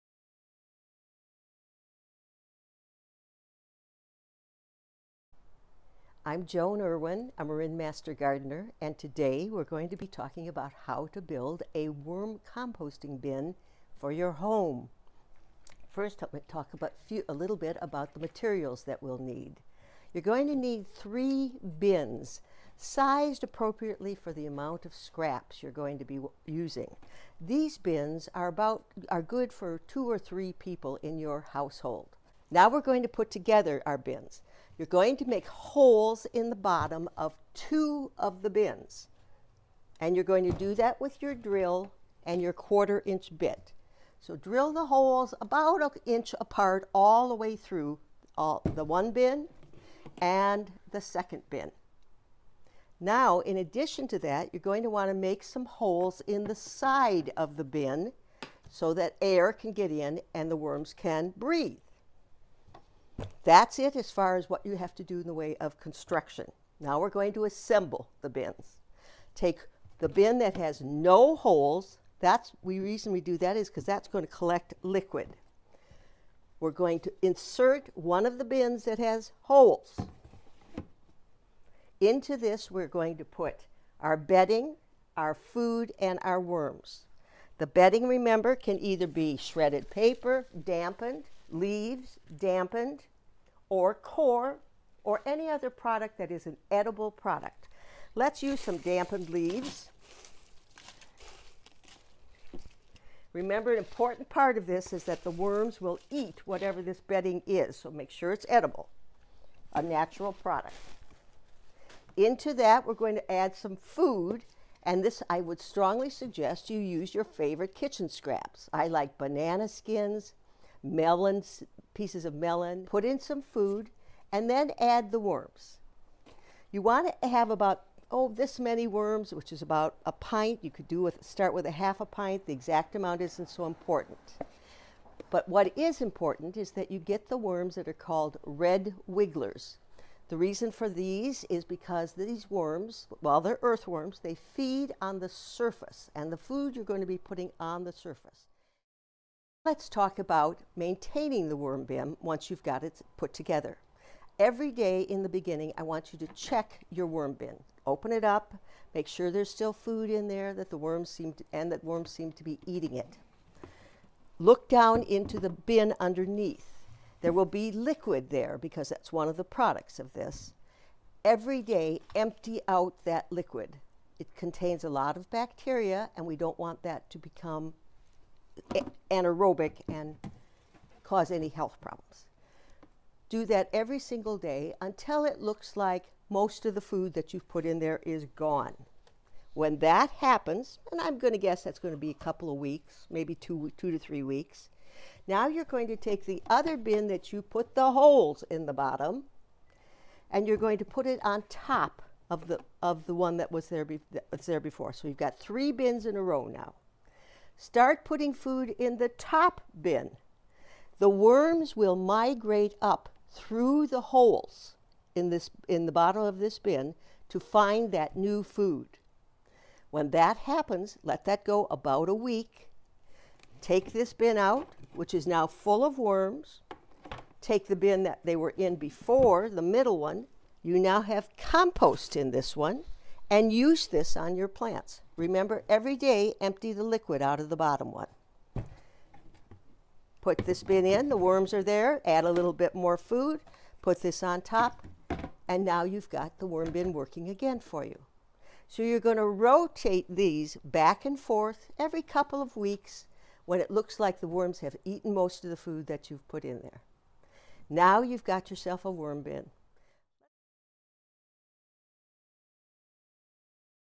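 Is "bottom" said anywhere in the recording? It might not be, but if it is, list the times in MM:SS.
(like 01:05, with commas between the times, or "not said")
00:36, 03:18, 03:35, 03:57.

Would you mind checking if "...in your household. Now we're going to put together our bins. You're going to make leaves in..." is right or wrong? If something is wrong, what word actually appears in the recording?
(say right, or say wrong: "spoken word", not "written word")
wrong: "holes", not "leaves".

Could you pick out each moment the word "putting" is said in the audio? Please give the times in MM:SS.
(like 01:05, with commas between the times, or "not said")
02:27, 03:28.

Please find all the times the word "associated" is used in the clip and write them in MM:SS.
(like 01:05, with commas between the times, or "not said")
not said.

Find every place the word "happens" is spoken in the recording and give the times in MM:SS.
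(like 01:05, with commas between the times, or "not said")
03:10, 03:40.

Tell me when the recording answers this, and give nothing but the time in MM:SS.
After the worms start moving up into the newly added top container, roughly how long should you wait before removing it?
03:41.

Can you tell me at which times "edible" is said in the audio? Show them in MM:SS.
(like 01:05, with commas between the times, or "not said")
01:36, 01:48.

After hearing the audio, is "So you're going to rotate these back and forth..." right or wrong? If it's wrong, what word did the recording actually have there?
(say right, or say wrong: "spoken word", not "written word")
right.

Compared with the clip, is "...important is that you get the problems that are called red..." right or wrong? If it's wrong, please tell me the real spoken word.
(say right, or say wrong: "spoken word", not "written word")
wrong: "worms", not "problems".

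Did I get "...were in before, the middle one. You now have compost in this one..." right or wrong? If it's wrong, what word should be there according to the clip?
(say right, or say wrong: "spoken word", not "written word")
right.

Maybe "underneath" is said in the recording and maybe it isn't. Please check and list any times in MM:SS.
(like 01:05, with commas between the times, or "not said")
02:45.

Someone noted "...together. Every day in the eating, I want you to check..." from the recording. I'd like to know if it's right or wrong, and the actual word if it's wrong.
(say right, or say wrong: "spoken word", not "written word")
wrong: "beginning", not "eating".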